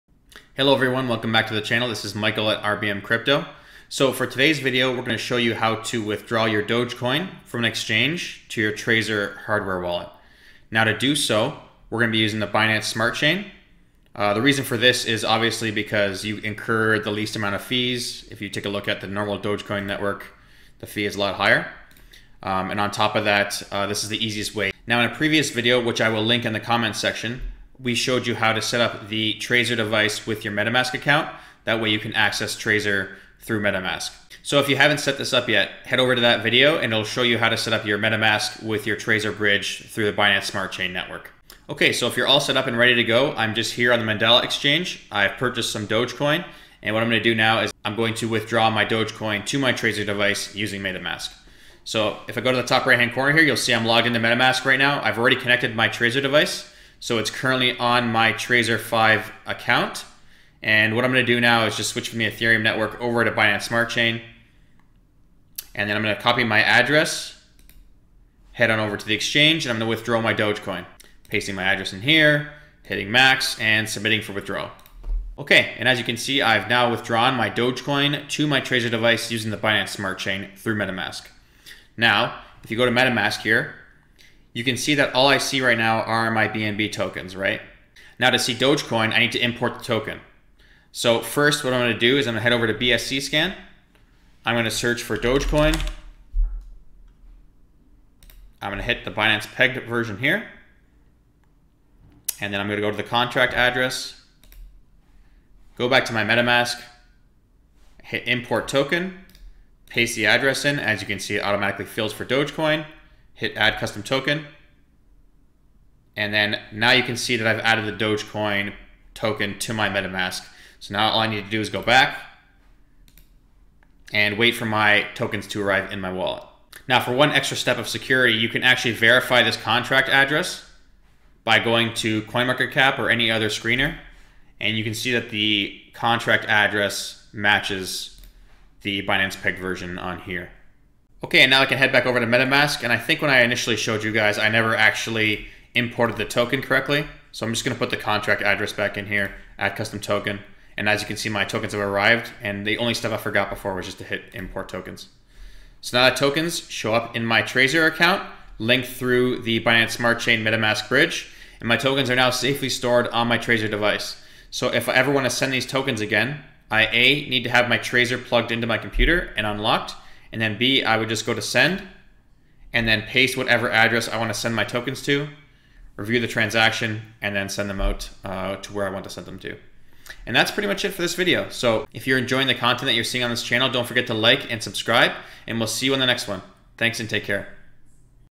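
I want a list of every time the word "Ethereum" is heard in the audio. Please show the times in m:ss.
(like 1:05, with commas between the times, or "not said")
1:02.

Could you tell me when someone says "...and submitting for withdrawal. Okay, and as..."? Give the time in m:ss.
1:13.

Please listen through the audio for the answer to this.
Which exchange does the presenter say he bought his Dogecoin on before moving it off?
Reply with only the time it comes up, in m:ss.
0:44.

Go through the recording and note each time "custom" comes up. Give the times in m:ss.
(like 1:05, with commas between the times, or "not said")
1:53, 2:29.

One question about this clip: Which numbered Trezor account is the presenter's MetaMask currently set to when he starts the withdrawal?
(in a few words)
Trezor 5.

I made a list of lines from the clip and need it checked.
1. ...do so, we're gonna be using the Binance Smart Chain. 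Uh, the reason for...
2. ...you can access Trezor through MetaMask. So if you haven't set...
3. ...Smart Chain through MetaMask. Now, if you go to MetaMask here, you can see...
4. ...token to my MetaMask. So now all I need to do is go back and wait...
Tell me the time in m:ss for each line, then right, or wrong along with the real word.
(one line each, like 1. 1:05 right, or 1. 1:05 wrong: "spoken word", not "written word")
1. 0:10 right
2. 0:31 right
3. 1:19 right
4. 1:59 right.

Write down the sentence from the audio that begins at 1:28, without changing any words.
Now to see Dogecoin, I need to import the token.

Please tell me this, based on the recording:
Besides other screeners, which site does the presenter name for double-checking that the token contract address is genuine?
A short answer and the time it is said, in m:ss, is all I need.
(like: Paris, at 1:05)
CoinMarketCap, at 2:12.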